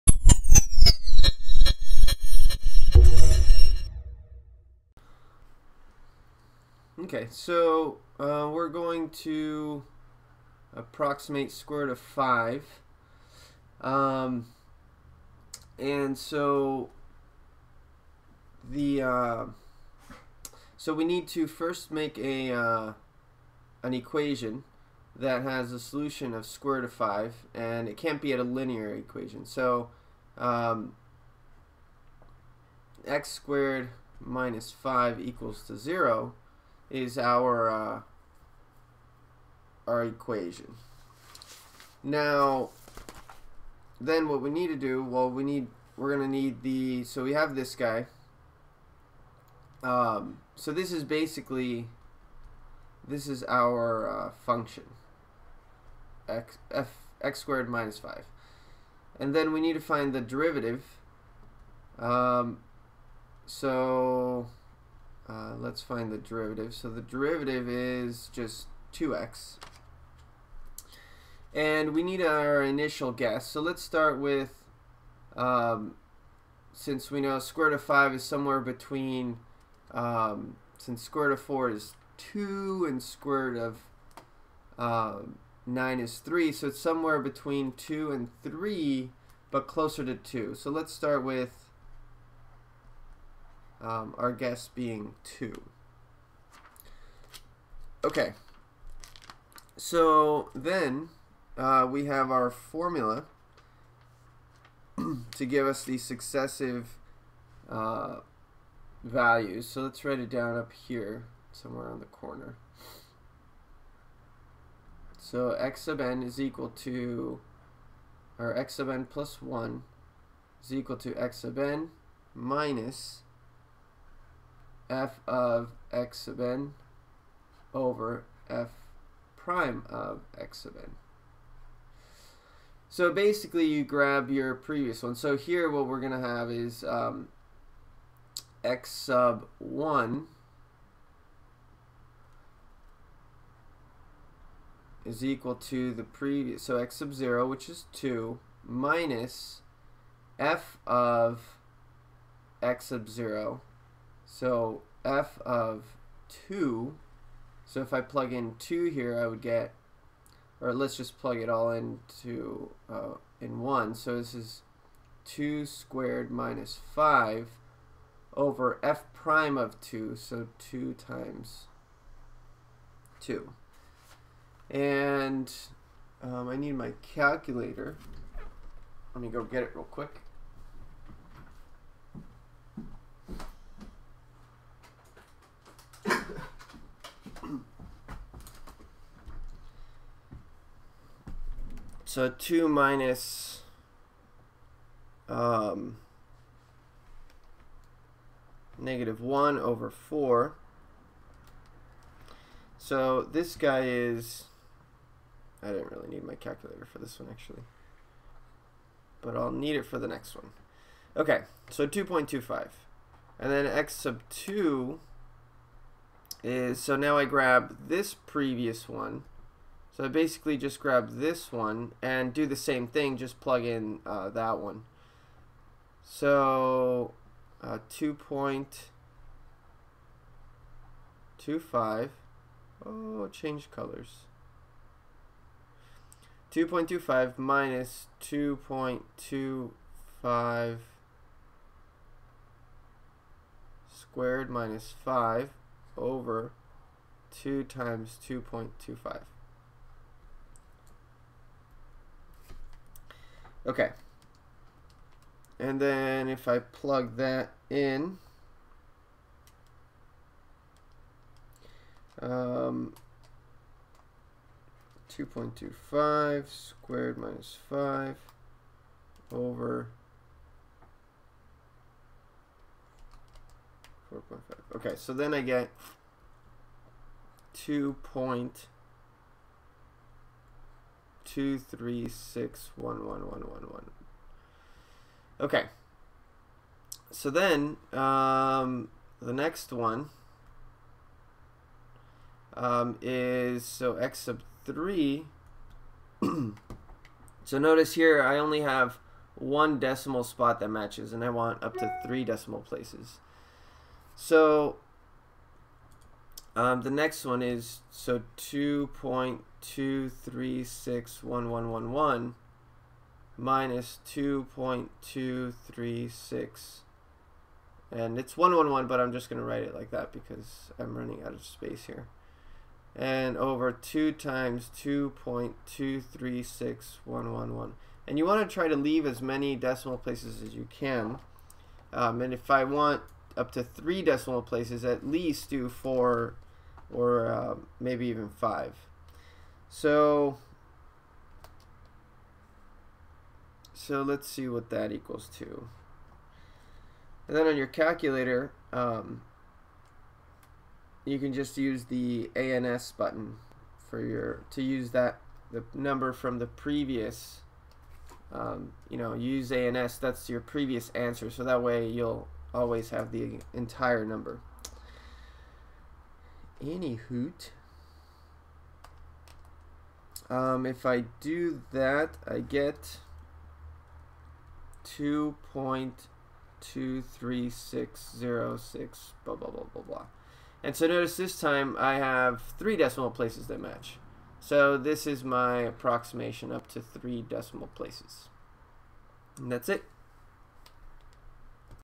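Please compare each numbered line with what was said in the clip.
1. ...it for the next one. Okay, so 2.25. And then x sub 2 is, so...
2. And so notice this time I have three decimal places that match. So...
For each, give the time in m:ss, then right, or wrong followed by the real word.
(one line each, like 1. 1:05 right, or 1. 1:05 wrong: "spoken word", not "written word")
1. 3:29 right
2. 6:20 right.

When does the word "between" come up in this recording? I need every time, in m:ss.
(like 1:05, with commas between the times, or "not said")
1:18, 1:27.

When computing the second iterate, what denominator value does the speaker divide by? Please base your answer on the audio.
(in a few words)
4.5.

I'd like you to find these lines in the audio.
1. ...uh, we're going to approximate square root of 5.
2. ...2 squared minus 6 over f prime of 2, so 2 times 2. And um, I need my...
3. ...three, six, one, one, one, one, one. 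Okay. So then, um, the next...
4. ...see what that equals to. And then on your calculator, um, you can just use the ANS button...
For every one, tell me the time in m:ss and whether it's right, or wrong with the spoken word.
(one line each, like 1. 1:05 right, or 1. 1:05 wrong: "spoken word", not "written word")
1. 0:08 right
2. 2:45 wrong: "5", not "6"
3. 4:41 right
4. 5:44 right.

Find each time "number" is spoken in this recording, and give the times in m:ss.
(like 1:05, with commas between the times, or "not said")
5:55, 6:04.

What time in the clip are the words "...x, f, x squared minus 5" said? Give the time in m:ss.
0:56.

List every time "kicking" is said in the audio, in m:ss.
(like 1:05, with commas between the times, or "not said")
not said.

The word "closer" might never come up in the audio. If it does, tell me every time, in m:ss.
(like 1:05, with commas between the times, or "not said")
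1:29.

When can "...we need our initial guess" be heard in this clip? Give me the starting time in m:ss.
1:11.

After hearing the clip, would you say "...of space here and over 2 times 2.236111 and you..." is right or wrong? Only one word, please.
right.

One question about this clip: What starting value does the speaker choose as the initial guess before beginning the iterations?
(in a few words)
2.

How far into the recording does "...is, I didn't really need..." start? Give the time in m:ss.
3:23.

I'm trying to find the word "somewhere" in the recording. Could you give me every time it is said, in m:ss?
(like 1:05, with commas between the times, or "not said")
1:18, 1:26, 1:51.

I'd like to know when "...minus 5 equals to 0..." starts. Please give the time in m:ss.
0:34.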